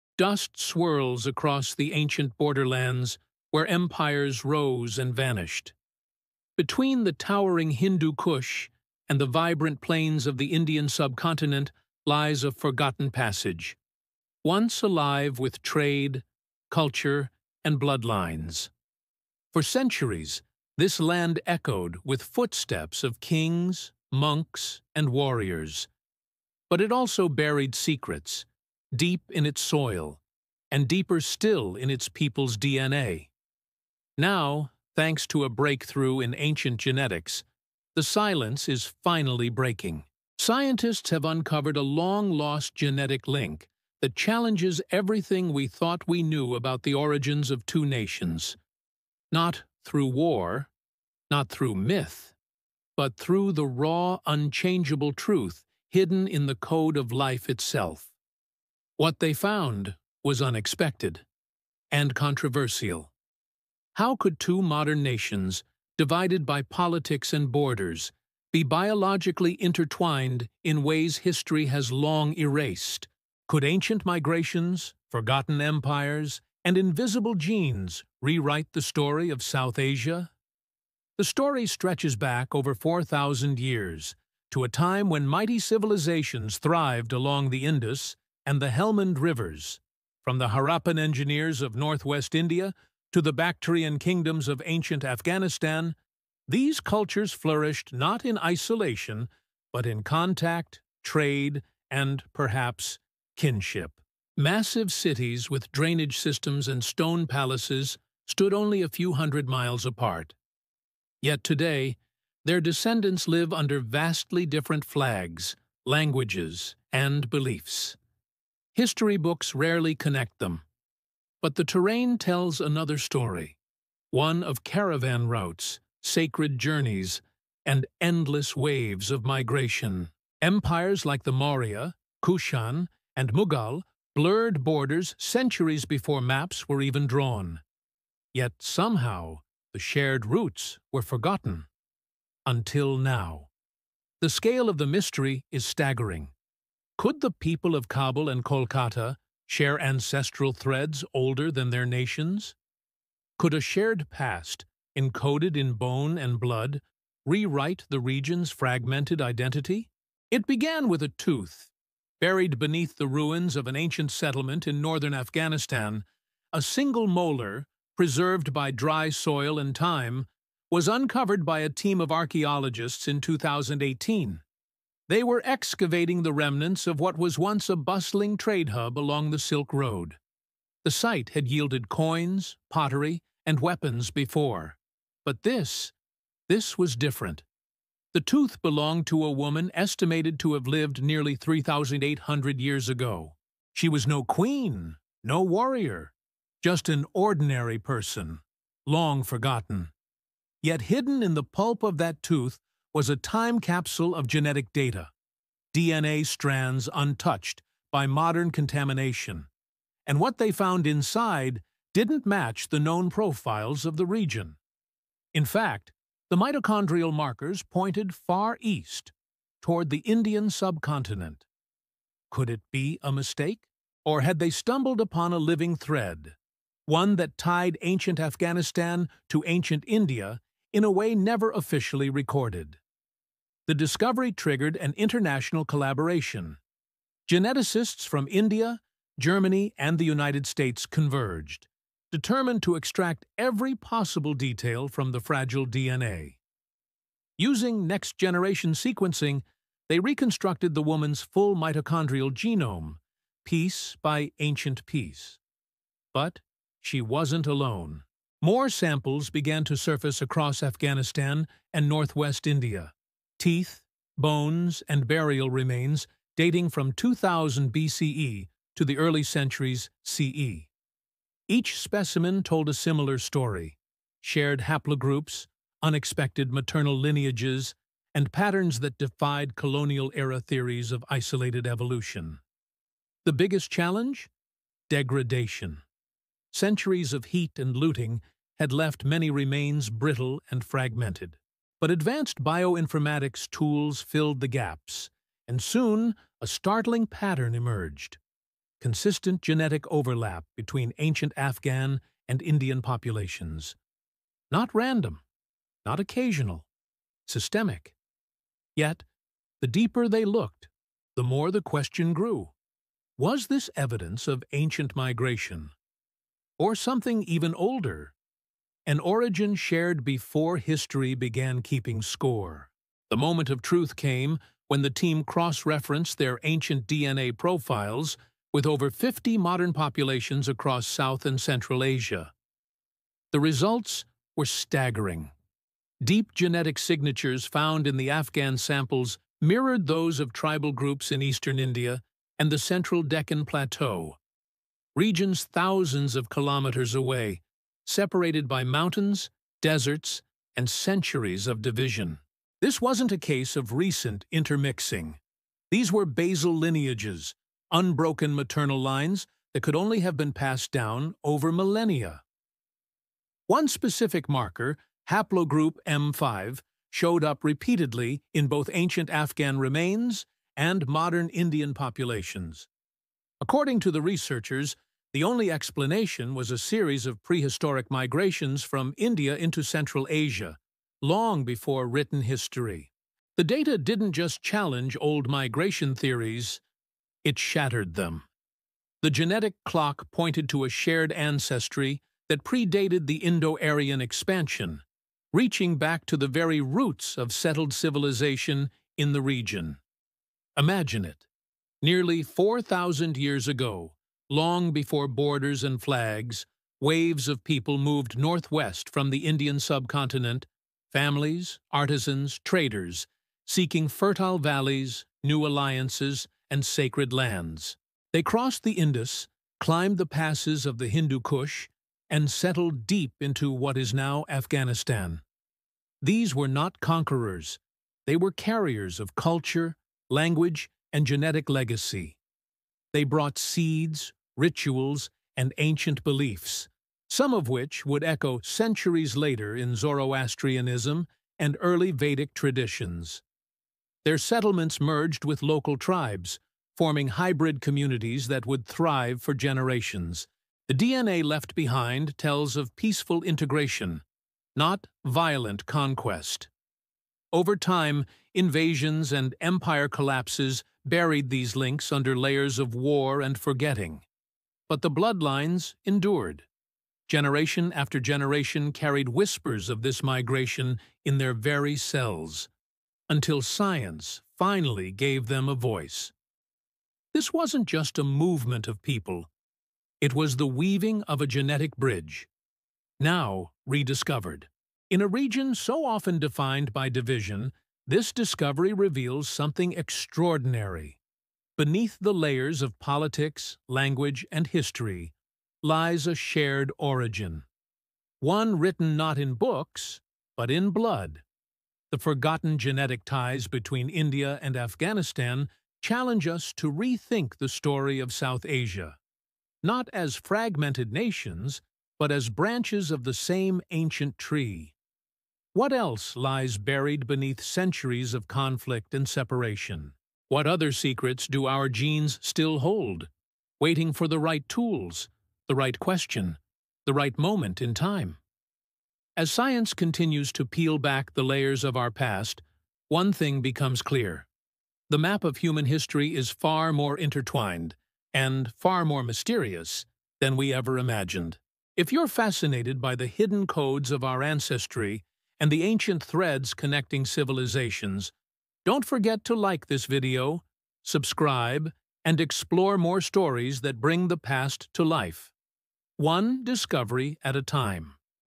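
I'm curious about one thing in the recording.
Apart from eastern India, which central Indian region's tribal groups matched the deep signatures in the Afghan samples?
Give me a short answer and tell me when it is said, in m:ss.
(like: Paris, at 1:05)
Deccan Plateau, at 5:43.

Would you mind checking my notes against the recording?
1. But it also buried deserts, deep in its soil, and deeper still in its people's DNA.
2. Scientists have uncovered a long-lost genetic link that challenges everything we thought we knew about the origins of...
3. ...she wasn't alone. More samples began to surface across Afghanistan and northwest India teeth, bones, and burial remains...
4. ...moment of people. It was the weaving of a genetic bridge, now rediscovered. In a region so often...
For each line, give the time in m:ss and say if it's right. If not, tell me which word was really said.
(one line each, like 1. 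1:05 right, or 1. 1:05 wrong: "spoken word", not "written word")
1. 0:26 wrong: "secrets", not "deserts"
2. 0:40 right
3. 4:16 right
4. 7:58 wrong: "movement", not "moment".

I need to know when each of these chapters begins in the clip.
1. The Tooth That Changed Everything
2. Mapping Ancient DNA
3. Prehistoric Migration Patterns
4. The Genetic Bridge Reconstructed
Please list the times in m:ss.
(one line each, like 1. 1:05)
1. 1:35
2. 3:40
3. 6:15
4. 9:10.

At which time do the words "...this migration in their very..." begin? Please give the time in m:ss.
7:49.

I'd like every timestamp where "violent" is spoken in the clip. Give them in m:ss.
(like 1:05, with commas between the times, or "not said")
7:35.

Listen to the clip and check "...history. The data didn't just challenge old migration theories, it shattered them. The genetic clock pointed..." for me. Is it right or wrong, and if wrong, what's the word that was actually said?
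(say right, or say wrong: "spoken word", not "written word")
right.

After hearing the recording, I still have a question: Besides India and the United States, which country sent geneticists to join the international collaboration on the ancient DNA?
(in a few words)
Germany.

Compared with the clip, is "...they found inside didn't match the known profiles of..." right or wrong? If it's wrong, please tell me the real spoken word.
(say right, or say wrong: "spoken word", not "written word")
right.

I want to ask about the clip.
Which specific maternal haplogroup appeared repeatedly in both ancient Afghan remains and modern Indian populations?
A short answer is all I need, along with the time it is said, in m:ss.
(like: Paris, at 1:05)
M5, at 6:05.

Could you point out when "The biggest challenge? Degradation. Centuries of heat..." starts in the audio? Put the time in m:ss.
4:43.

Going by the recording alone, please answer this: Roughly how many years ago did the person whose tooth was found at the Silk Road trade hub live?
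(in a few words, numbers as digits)
3,800.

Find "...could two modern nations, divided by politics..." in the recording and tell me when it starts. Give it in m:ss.
1:04.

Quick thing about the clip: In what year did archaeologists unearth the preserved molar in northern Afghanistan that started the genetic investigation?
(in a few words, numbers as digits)
2018.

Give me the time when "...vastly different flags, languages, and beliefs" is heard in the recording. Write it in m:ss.
1:53.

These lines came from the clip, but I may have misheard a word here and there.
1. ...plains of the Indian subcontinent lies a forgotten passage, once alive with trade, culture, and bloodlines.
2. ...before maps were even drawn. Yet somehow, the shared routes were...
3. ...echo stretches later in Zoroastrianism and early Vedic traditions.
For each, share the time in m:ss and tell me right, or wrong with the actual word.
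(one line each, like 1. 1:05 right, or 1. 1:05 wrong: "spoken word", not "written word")
1. 0:09 right
2. 2:15 right
3. 7:18 wrong: "centuries", not "stretches".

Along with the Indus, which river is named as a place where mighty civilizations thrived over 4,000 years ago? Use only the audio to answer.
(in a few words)
Helmand.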